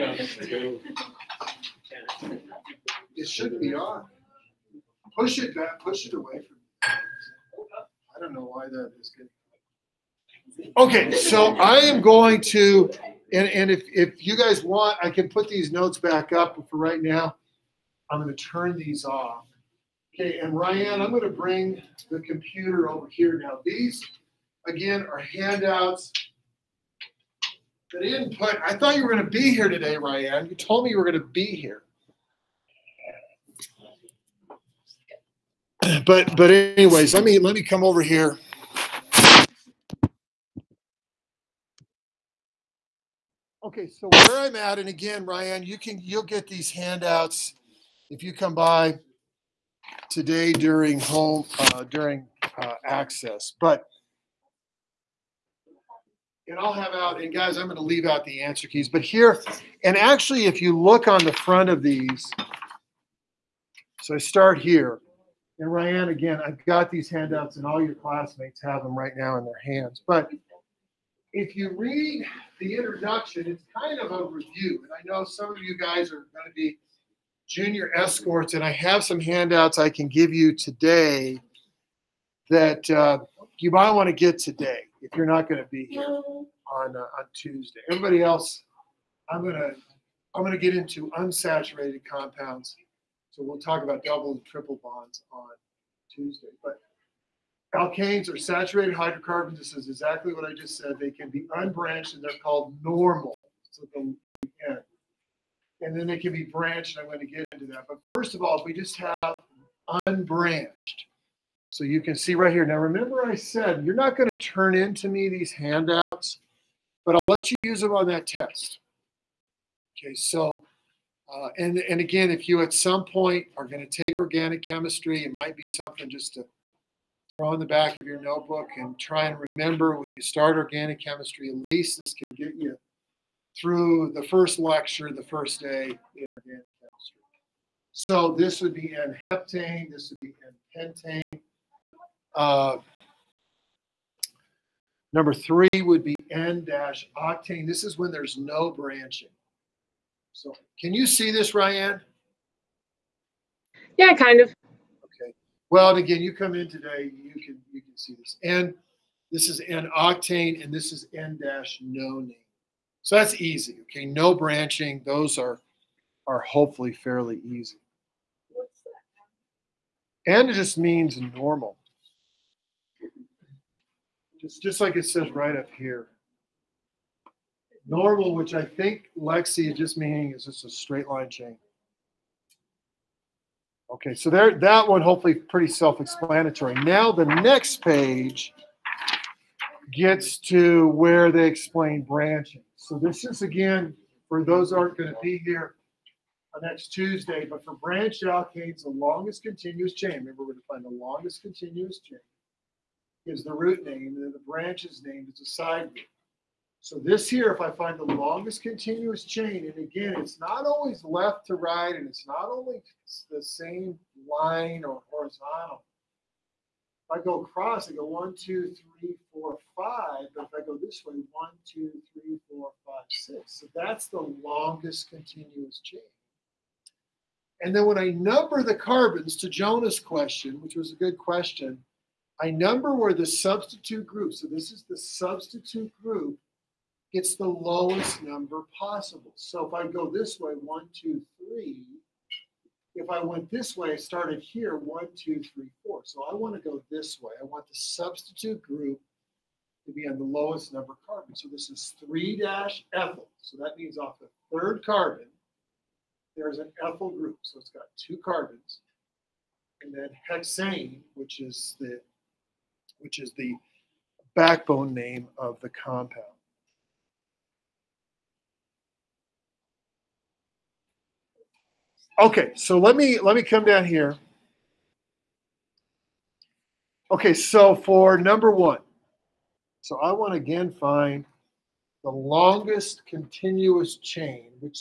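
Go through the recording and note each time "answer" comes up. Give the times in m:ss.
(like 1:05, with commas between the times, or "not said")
0:58.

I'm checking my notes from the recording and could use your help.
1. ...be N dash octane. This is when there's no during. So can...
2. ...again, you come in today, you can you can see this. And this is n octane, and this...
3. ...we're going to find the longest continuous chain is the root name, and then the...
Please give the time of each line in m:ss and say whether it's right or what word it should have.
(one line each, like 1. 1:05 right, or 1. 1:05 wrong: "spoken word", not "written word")
1. 2:26 wrong: "branching", not "during"
2. 2:35 right
3. 3:20 right.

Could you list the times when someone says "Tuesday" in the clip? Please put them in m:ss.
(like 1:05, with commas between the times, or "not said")
1:27, 1:36, 3:16.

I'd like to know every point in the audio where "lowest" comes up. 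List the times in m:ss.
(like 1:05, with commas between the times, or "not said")
3:57, 4:10.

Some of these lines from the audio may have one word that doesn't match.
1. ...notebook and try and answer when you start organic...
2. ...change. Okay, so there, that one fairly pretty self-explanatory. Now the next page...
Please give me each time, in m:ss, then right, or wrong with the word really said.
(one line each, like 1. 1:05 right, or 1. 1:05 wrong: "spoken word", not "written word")
1. 2:08 wrong: "remember", not "answer"
2. 3:01 wrong: "hopefully", not "fairly".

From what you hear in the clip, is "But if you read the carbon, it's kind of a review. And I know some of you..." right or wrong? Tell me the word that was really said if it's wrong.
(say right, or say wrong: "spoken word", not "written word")
wrong: "introduction", not "carbon".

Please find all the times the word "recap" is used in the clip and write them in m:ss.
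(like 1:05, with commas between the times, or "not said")
not said.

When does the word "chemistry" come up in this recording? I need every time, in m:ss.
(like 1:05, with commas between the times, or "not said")
2:04, 2:11, 2:16.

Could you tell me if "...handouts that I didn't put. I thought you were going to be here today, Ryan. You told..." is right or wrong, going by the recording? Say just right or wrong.
right.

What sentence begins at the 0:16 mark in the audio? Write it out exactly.
But for right now, I'm going to turn these off.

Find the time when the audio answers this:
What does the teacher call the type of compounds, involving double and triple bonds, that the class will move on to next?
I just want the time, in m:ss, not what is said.
1:31.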